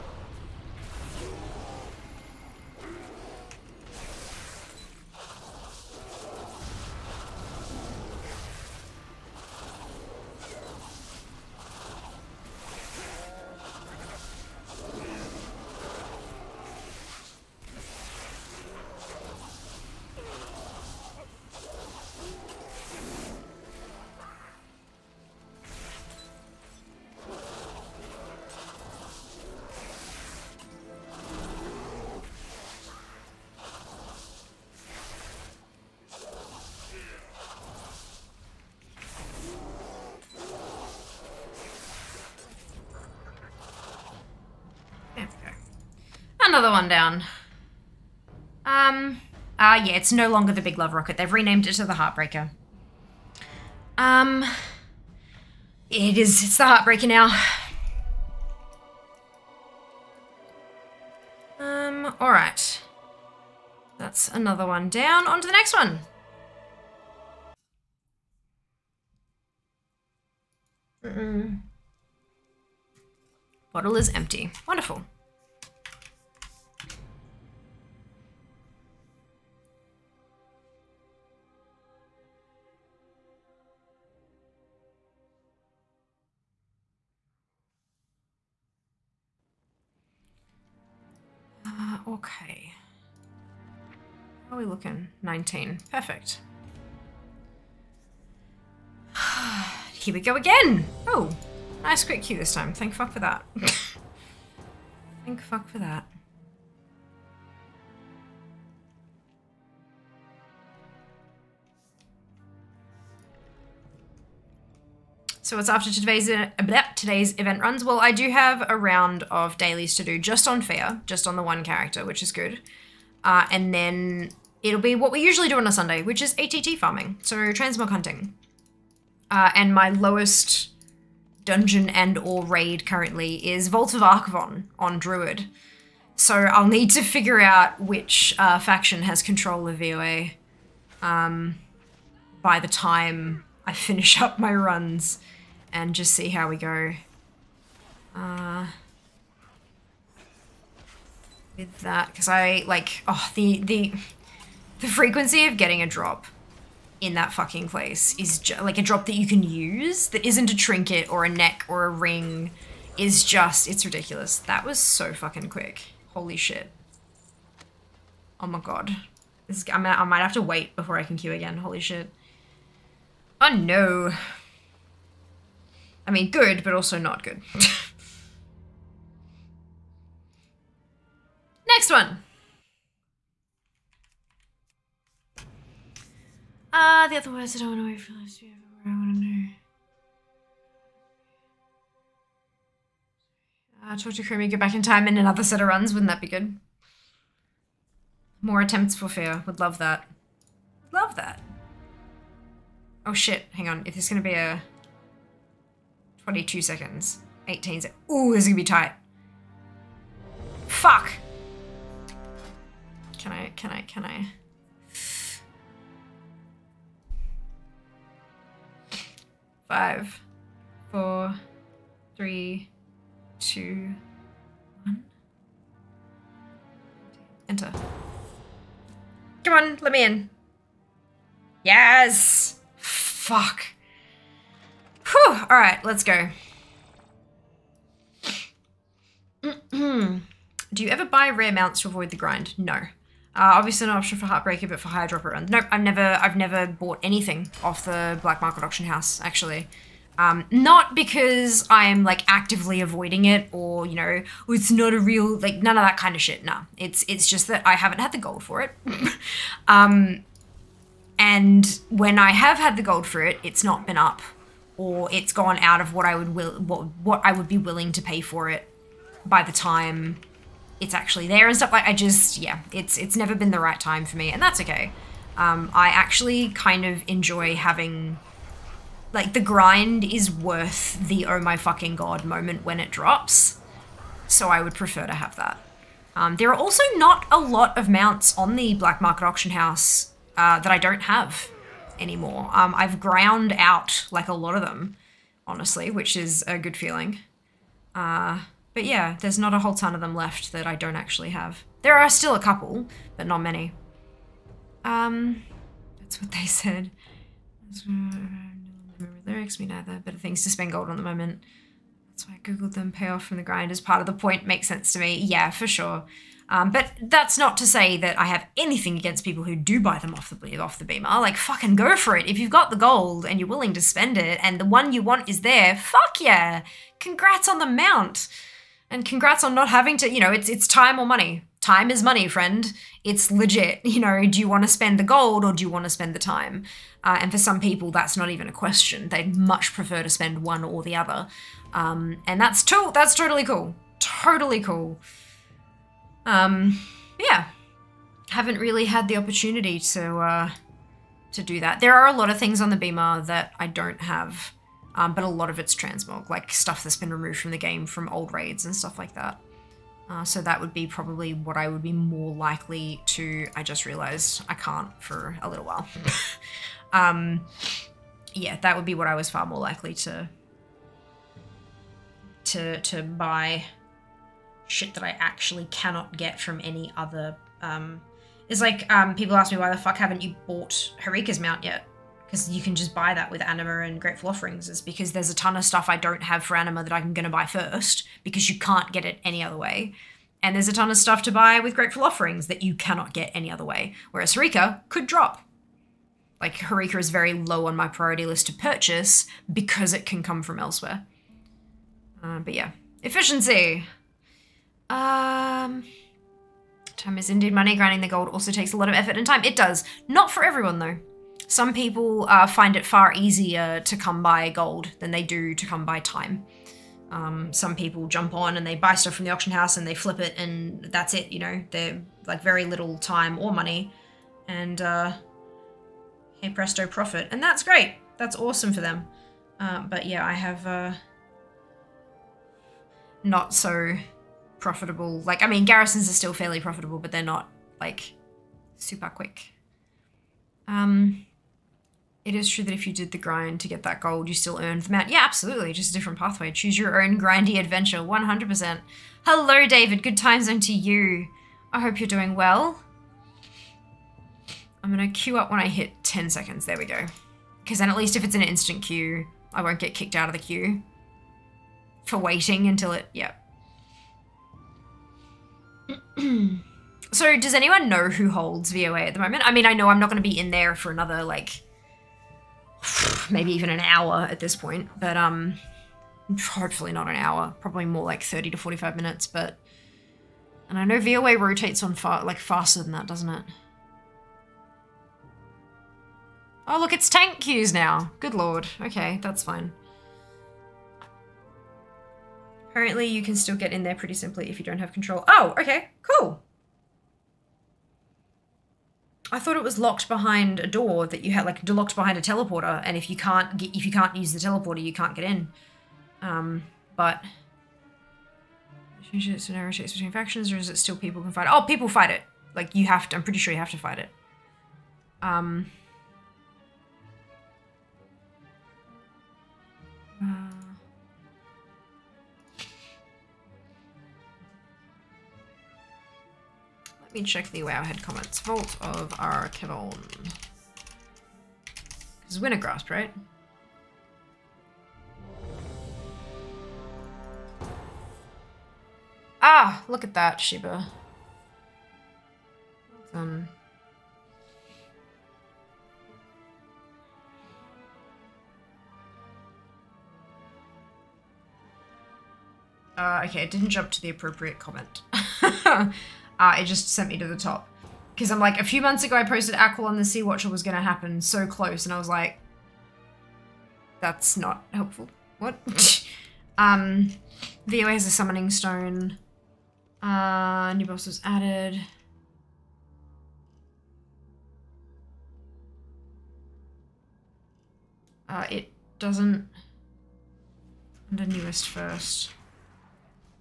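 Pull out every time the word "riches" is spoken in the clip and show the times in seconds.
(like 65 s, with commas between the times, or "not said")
not said.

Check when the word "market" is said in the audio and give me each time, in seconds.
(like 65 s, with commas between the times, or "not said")
248 s, 289 s.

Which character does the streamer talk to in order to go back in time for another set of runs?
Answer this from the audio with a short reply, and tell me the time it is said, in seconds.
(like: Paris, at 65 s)
Chromie, at 194 s.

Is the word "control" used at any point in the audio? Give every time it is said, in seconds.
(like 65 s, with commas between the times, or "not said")
139 s, 494 s.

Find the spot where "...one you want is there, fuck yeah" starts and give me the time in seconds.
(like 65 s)
324 s.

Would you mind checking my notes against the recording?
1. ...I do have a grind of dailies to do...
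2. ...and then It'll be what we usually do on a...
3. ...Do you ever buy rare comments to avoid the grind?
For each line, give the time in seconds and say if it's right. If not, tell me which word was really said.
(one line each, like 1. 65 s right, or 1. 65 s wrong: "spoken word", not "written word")
1. 118 s wrong: "round", not "grind"
2. 123 s right
3. 239 s wrong: "mounts", not "comments".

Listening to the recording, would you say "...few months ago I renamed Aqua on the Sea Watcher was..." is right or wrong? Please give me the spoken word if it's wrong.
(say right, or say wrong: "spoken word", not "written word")
wrong: "posted", not "renamed".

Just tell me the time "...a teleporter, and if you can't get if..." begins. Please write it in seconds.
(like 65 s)
502 s.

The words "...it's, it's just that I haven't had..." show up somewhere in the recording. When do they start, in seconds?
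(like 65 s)
256 s.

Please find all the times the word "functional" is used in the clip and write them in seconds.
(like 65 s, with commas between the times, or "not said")
not said.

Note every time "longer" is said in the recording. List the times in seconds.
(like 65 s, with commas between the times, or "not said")
50 s.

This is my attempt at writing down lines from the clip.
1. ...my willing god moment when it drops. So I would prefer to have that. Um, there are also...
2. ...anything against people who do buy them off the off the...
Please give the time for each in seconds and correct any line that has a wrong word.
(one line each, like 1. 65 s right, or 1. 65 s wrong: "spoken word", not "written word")
1. 281 s wrong: "fucking", not "willing"
2. 318 s right.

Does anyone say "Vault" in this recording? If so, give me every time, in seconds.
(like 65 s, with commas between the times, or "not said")
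133 s, 528 s.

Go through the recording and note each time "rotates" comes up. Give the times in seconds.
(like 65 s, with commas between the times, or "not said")
481 s.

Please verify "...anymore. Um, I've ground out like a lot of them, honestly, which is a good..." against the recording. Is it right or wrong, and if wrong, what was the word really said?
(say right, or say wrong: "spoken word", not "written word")
right.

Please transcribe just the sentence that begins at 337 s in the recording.
Uh, and for some people, that's not even a question.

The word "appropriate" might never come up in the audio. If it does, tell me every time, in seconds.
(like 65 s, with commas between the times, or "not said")
554 s.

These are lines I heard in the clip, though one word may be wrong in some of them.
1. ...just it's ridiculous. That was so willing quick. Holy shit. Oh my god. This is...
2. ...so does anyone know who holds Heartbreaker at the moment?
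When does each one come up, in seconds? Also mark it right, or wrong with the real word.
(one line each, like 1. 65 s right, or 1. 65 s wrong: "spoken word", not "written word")
1. 163 s wrong: "fucking", not "willing"
2. 467 s wrong: "VOA", not "Heartbreaker".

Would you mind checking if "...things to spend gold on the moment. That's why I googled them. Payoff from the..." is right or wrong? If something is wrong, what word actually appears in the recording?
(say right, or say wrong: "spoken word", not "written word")
right.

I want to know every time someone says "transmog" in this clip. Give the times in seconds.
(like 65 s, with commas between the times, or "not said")
127 s, 355 s.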